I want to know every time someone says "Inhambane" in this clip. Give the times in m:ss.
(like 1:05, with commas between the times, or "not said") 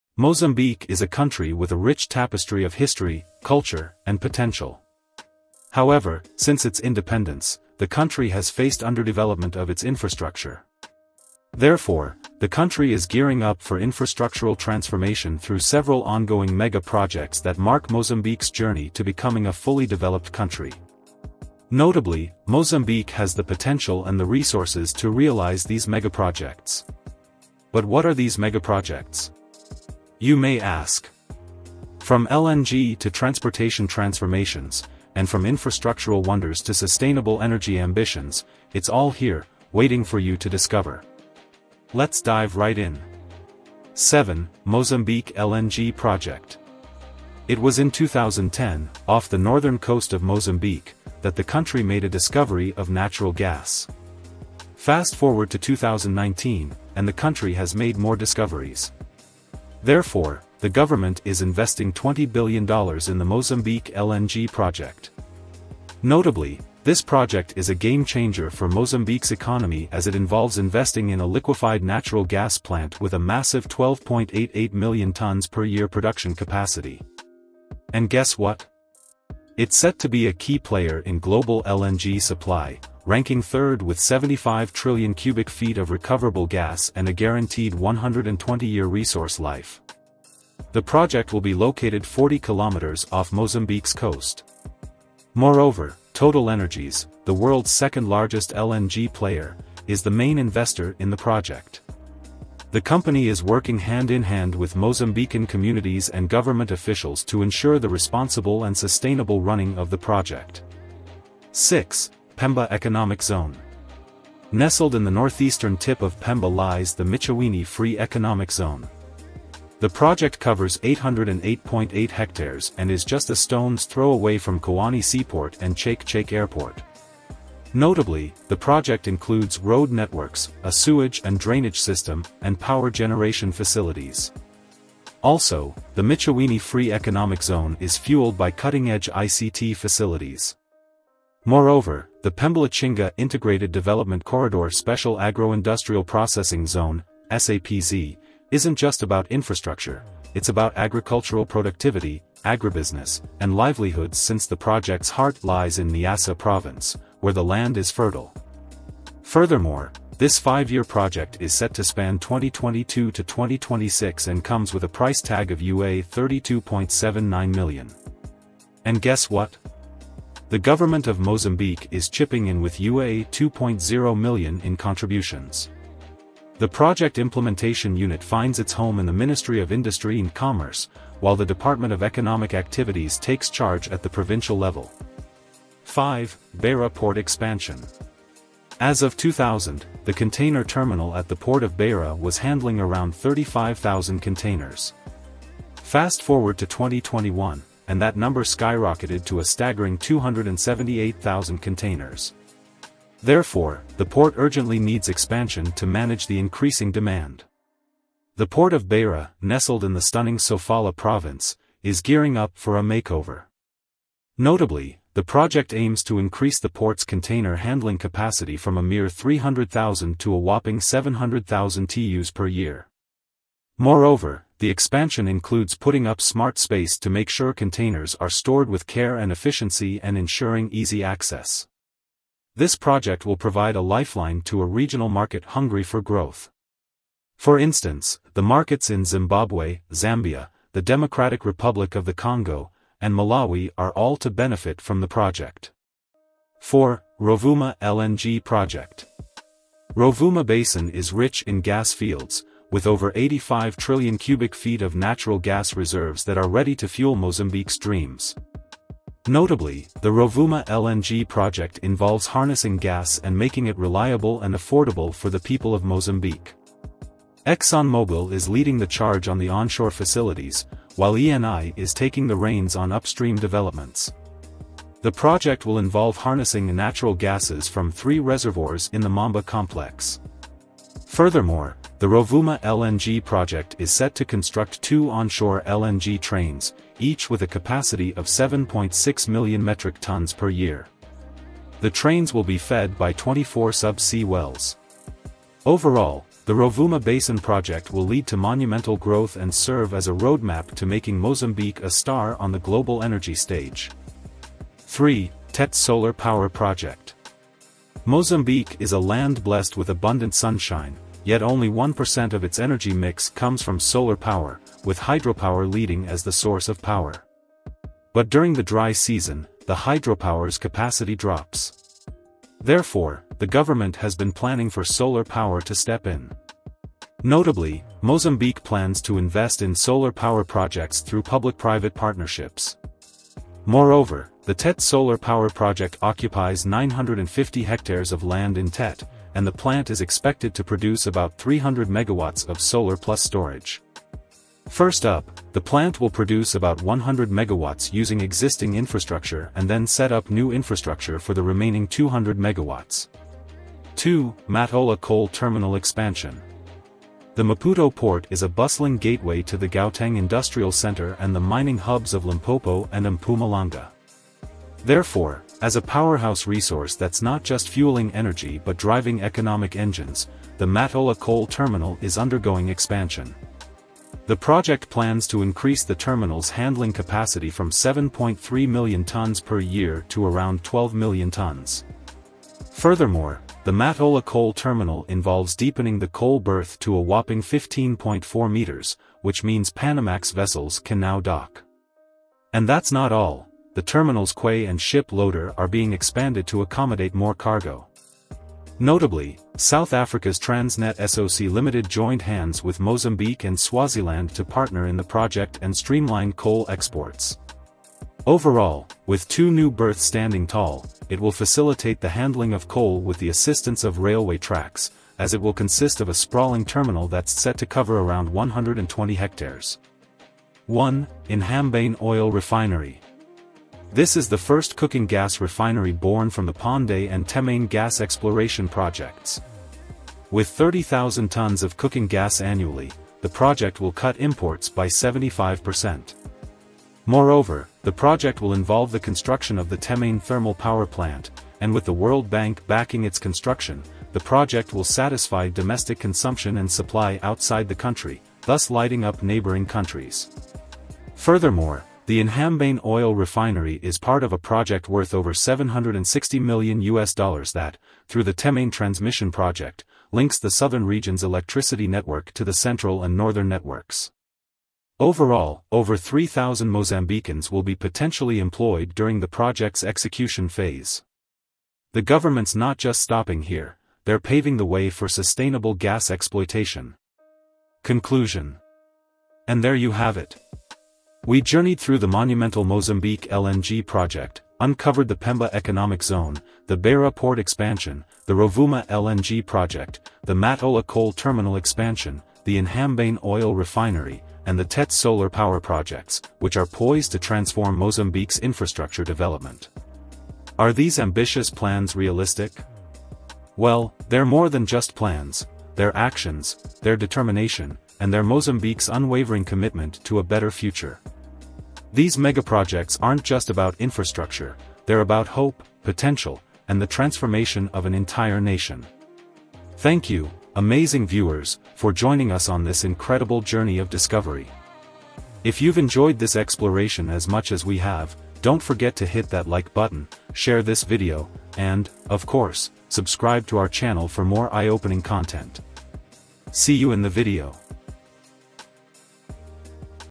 7:01, 7:32, 8:12.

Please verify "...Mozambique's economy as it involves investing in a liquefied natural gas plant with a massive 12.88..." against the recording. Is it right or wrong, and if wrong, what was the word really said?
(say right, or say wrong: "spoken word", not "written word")
right.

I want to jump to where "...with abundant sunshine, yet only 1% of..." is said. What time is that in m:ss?
5:09.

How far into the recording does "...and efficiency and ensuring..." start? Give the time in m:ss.
3:49.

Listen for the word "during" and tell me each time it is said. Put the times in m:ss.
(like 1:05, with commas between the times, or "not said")
5:18, 7:48.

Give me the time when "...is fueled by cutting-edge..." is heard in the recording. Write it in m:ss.
2:17.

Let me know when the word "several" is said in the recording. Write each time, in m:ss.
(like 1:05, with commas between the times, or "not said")
0:15.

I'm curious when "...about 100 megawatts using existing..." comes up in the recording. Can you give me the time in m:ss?
5:46.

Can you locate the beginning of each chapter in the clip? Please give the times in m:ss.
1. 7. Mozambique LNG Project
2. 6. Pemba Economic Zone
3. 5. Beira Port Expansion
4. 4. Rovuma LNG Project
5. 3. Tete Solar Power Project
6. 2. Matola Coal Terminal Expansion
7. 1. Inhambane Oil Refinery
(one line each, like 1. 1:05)
1. 0:44
2. 1:51
3. 3:06
4. 4:07
5. 5:06
6. 5:55
7. 7:02.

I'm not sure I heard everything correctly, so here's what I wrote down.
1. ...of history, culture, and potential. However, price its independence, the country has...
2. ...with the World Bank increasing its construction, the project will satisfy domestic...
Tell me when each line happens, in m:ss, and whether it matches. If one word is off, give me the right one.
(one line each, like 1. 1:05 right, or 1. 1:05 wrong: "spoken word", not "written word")
1. 0:02 wrong: "since", not "price"
2. 7:21 wrong: "backing", not "increasing".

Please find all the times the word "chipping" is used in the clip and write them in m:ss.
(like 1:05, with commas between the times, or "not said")
2:52.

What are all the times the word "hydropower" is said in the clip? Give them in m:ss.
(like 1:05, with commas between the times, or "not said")
5:14, 5:19.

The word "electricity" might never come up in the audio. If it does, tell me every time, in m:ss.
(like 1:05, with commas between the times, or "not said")
7:41.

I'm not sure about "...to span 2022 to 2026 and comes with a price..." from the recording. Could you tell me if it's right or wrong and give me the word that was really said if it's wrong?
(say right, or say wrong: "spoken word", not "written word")
right.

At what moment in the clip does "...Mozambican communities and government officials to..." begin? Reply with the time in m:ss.
1:44.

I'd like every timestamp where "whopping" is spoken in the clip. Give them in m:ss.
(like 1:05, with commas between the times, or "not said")
3:40, 6:27.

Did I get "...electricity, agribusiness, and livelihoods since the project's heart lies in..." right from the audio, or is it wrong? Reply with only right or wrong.
wrong.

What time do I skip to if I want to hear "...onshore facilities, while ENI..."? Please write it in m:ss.
4:29.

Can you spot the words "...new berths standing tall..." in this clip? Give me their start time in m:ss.
6:49.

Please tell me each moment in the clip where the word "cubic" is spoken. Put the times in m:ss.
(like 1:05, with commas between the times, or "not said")
1:25, 4:14.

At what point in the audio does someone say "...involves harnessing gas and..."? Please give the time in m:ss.
4:21.